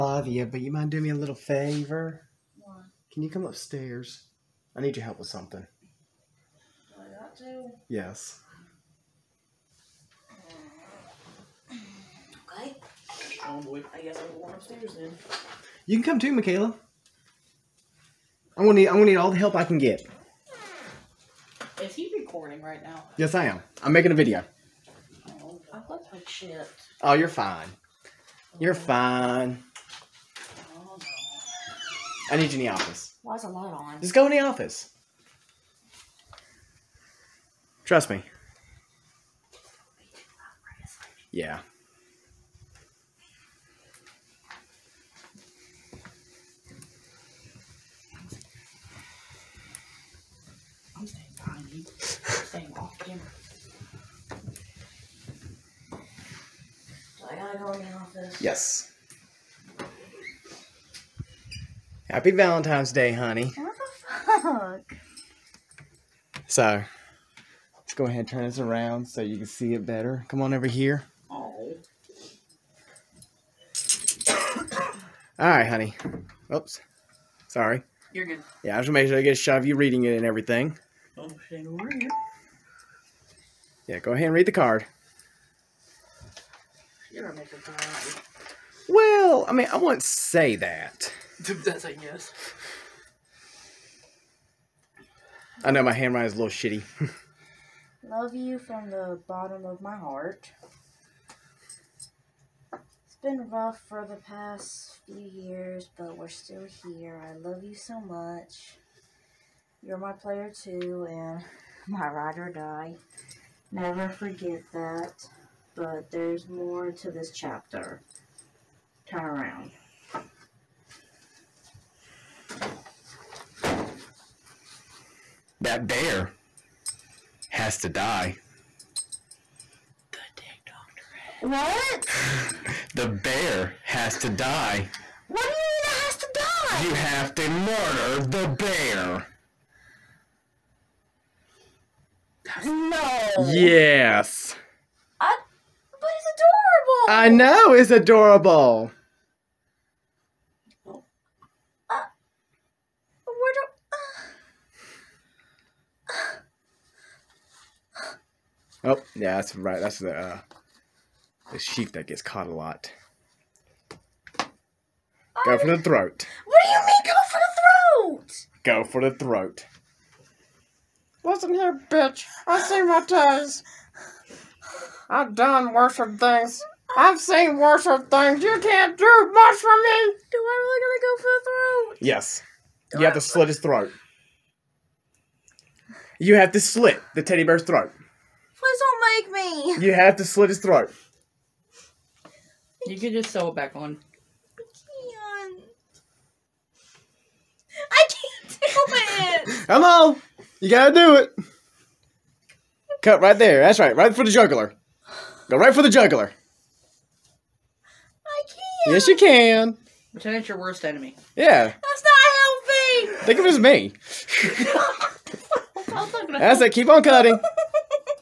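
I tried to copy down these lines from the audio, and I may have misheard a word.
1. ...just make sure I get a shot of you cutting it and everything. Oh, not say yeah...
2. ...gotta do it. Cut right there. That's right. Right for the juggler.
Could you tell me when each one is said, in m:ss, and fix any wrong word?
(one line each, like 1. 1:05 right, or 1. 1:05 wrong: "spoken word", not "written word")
1. 1:18 wrong: "reading", not "cutting"
2. 3:20 right.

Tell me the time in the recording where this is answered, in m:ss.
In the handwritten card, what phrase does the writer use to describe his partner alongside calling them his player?
1:52.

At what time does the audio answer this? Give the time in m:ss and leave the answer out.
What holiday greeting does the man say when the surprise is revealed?
1:02.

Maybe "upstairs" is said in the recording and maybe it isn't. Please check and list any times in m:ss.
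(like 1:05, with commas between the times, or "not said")
0:03, 0:14.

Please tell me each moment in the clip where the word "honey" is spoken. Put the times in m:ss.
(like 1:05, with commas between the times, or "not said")
1:03, 1:15.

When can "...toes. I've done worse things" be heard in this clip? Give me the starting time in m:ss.
2:53.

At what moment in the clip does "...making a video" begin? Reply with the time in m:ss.
0:23.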